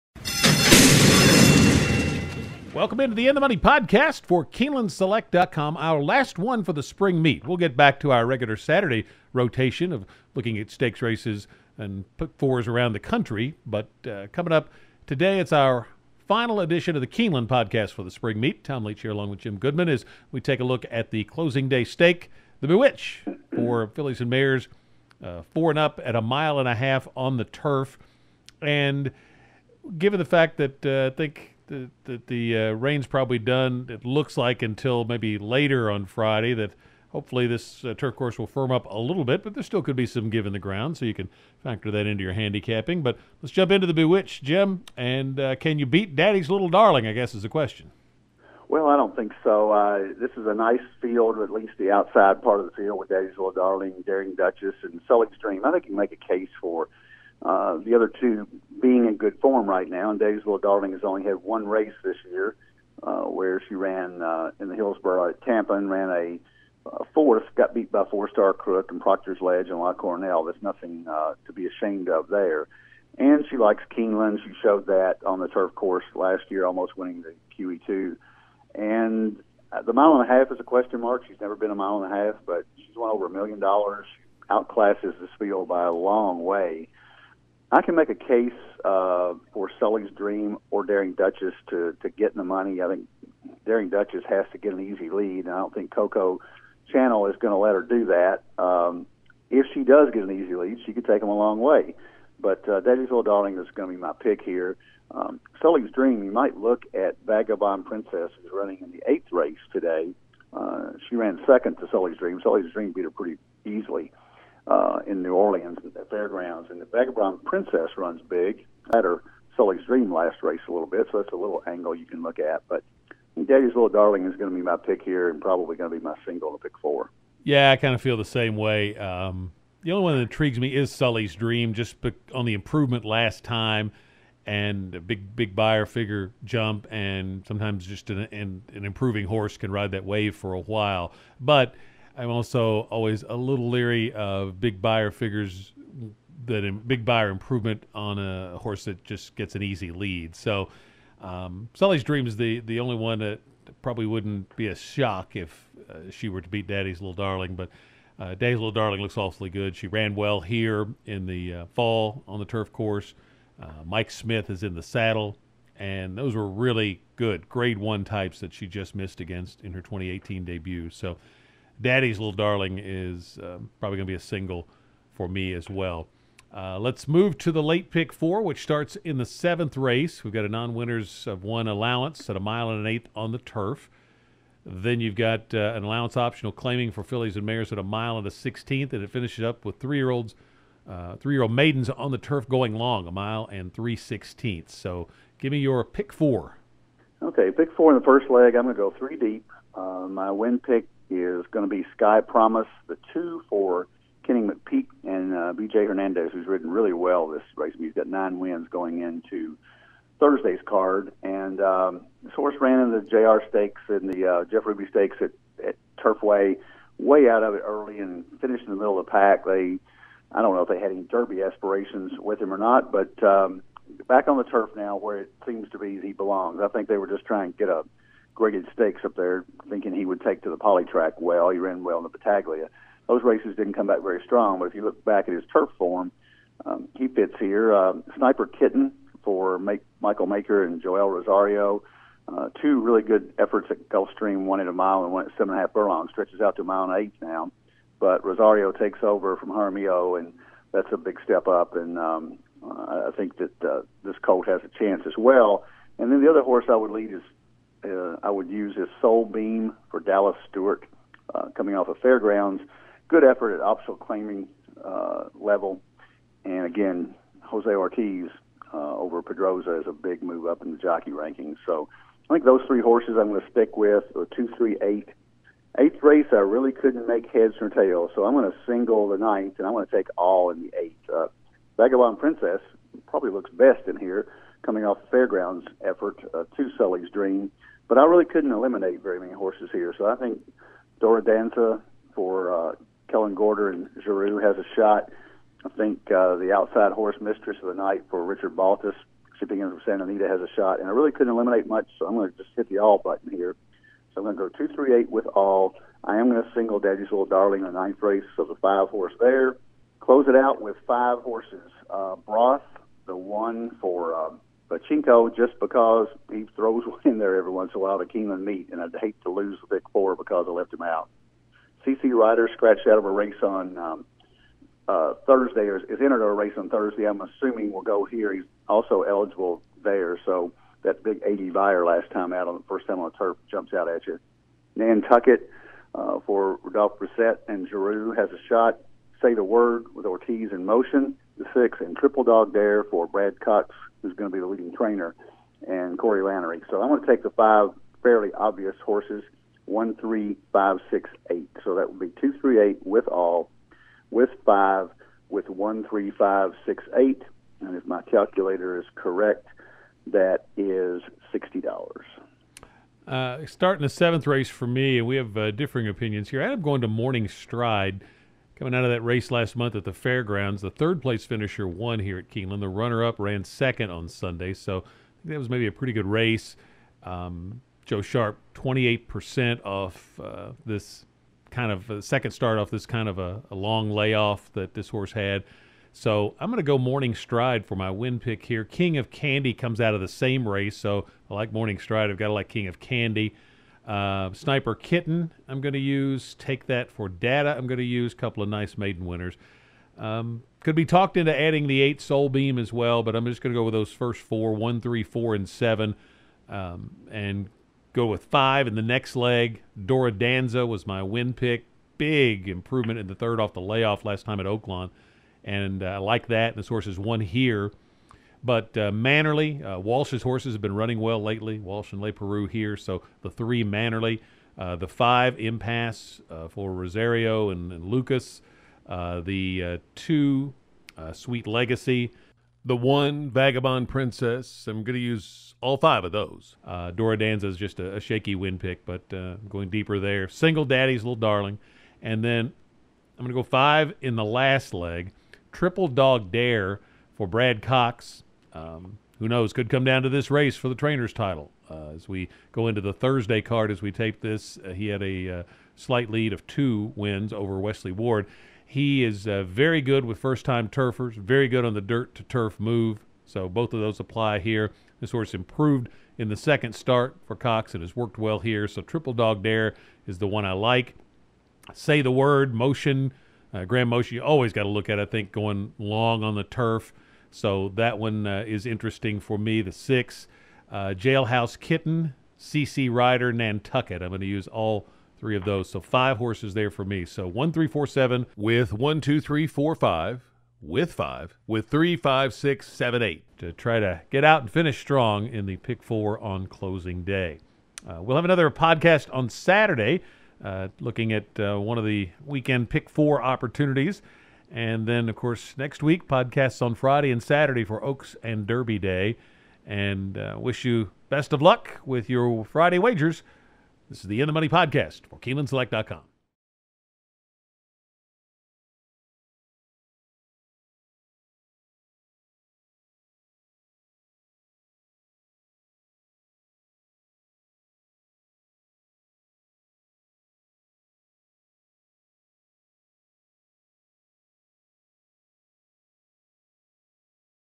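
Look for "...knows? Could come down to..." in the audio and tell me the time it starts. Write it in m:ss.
7:29.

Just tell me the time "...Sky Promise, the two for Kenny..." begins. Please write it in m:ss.
3:21.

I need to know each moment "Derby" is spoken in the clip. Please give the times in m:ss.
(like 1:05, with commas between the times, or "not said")
3:41, 8:28.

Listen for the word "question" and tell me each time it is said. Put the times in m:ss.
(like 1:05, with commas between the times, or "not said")
0:47, 1:20.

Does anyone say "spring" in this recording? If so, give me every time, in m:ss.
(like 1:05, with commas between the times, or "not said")
0:06, 0:18.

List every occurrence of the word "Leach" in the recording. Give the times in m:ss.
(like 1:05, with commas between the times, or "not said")
0:18.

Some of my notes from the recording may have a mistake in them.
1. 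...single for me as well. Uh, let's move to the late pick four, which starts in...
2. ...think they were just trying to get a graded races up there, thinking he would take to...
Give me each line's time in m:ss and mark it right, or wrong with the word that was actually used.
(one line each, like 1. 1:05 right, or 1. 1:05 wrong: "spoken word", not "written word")
1. 2:54 right
2. 3:46 wrong: "stakes", not "races".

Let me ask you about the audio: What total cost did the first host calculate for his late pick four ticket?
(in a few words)
$60.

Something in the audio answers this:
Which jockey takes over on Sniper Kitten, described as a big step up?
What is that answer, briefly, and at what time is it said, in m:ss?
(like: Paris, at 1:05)
Joel Rosario, at 4:00.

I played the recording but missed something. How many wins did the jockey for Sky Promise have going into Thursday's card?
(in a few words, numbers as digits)
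9.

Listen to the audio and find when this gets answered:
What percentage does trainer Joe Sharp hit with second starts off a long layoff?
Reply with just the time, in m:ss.
6:18.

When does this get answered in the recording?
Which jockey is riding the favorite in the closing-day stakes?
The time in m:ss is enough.
2:43.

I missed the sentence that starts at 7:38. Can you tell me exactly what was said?
He is uh, very good with first time turfers, very good on the dirt to turf move.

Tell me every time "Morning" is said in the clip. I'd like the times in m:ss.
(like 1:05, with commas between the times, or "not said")
6:06, 6:26, 6:31.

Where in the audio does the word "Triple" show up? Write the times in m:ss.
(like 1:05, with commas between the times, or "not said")
5:41, 7:25, 7:48.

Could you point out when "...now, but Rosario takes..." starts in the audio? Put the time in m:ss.
4:07.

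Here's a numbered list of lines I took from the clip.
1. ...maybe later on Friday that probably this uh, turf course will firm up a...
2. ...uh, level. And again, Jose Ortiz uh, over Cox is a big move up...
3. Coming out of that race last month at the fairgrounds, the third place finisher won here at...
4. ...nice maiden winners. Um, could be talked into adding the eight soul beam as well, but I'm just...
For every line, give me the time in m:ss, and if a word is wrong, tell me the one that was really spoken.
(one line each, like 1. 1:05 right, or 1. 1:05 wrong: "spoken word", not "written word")
1. 0:35 wrong: "hopefully", not "probably"
2. 4:24 wrong: "Pedroza", not "Cox"
3. 6:08 right
4. 6:38 right.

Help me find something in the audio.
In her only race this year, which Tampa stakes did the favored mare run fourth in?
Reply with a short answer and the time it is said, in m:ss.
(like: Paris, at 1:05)
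Hillsborough, at 1:04.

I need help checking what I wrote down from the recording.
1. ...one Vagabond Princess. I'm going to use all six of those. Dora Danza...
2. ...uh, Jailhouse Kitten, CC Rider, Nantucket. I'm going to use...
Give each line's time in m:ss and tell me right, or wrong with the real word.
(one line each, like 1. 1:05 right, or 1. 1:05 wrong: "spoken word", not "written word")
1. 7:12 wrong: "five", not "six"
2. 8:00 right.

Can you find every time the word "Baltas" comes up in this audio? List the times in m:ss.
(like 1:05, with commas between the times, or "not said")
4:58.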